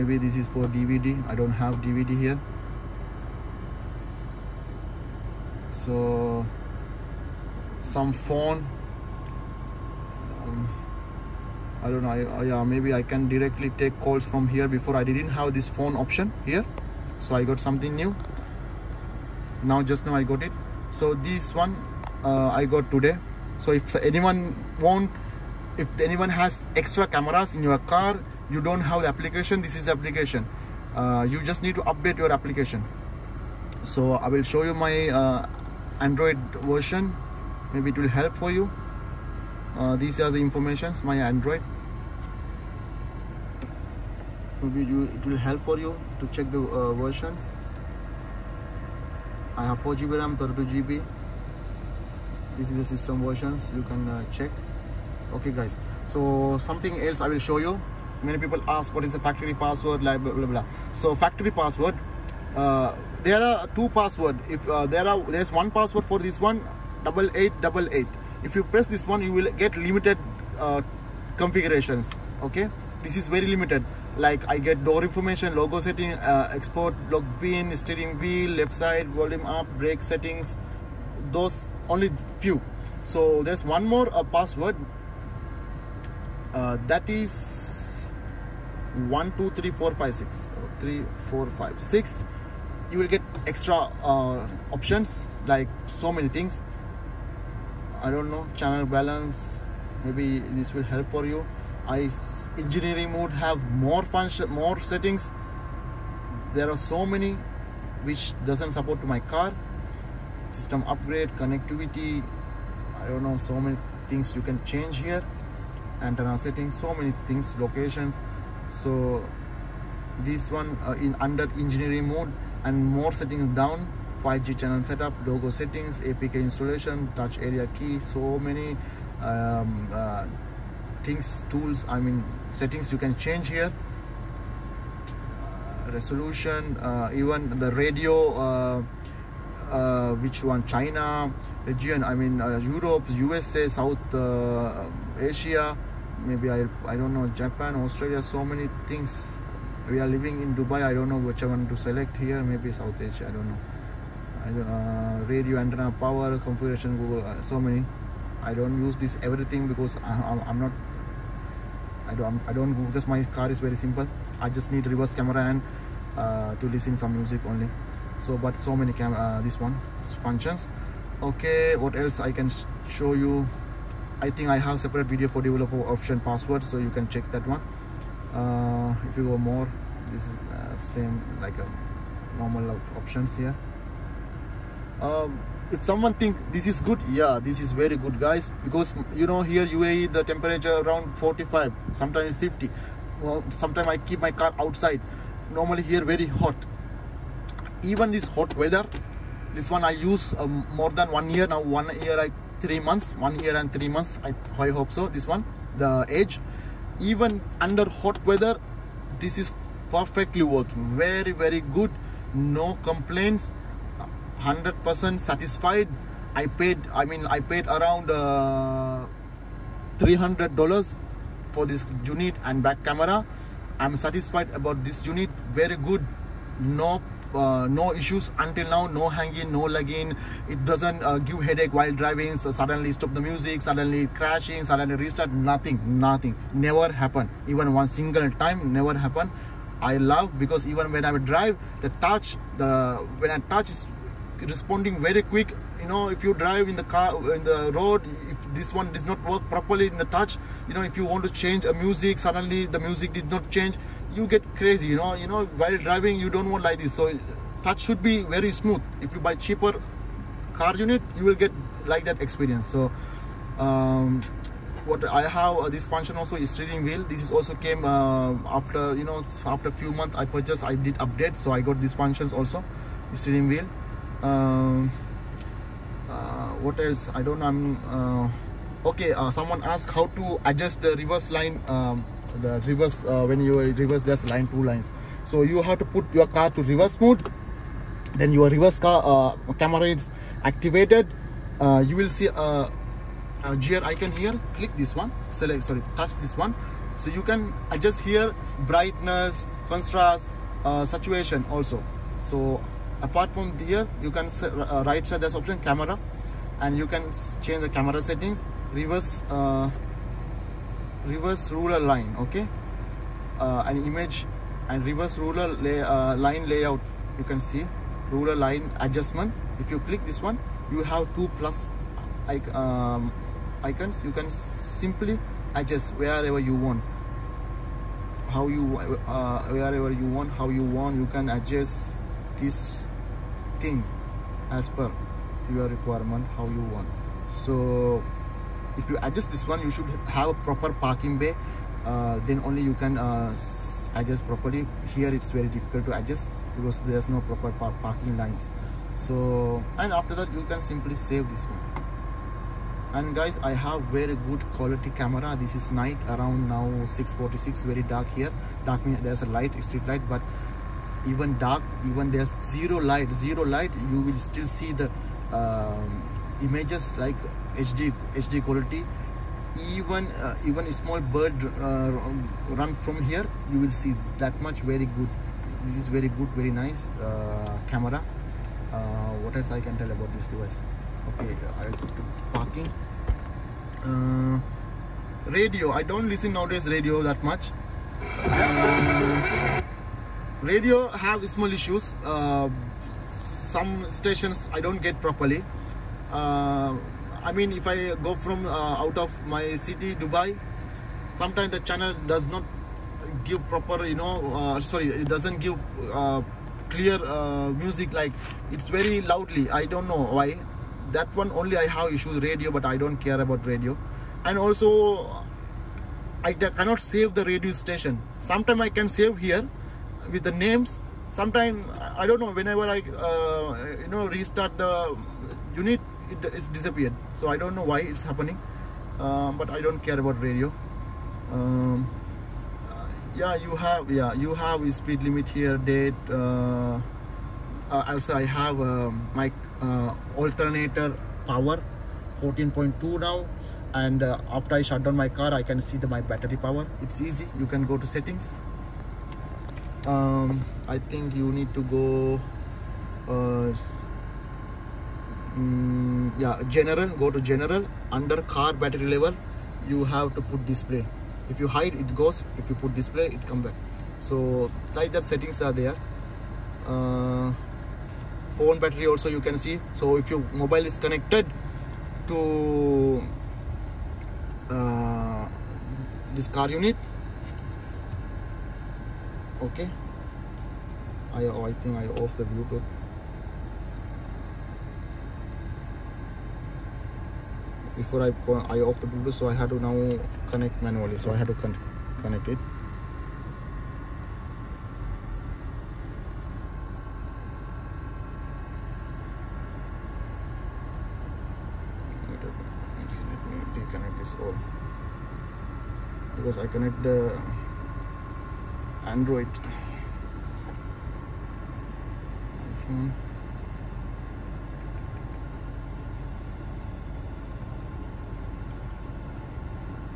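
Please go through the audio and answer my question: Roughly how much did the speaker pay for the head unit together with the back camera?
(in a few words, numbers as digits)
$300.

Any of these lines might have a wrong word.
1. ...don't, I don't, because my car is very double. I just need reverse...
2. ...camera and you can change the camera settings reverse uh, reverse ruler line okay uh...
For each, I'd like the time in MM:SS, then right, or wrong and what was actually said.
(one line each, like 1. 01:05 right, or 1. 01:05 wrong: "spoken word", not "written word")
1. 02:42 wrong: "simple", not "double"
2. 05:05 right.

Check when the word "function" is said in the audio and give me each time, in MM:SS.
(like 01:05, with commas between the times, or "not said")
01:44, 02:50, 04:25, 04:31.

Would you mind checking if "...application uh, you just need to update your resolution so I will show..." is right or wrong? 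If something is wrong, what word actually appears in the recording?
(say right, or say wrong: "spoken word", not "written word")
wrong: "application", not "resolution".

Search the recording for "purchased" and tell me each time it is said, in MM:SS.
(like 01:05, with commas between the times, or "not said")
04:30.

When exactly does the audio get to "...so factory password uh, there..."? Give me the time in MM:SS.
01:00.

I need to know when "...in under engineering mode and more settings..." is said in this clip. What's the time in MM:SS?
02:00.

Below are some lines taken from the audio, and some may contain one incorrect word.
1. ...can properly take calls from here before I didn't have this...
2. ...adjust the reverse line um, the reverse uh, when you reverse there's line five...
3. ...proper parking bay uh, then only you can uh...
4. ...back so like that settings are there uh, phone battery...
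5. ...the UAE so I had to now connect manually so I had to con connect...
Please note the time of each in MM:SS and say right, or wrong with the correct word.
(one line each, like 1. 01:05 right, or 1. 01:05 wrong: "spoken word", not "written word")
1. 00:13 wrong: "directly", not "properly"
2. 04:40 wrong: "two", not "five"
3. 05:40 right
4. 07:43 right
5. 08:08 wrong: "Bluetooth", not "UAE".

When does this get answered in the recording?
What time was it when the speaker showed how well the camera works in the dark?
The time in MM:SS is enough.
05:56.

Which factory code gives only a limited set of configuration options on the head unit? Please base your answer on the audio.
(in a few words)
8888.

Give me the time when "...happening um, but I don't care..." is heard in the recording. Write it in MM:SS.
07:08.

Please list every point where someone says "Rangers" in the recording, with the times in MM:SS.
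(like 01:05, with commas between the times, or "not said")
not said.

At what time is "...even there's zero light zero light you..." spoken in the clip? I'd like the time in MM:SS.
06:01.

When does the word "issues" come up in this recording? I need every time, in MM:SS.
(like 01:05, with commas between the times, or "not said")
03:47, 06:31, 06:51.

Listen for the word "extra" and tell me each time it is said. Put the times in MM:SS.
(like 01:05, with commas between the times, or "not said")
00:26, 01:33.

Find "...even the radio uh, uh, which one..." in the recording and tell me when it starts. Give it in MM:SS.
02:17.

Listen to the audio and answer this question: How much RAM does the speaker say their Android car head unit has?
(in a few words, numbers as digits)
4GB.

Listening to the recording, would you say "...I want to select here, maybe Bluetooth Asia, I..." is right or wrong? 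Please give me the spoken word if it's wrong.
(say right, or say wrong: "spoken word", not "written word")
wrong: "South", not "Bluetooth".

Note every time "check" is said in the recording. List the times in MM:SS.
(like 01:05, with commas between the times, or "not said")
00:46, 00:54, 02:57.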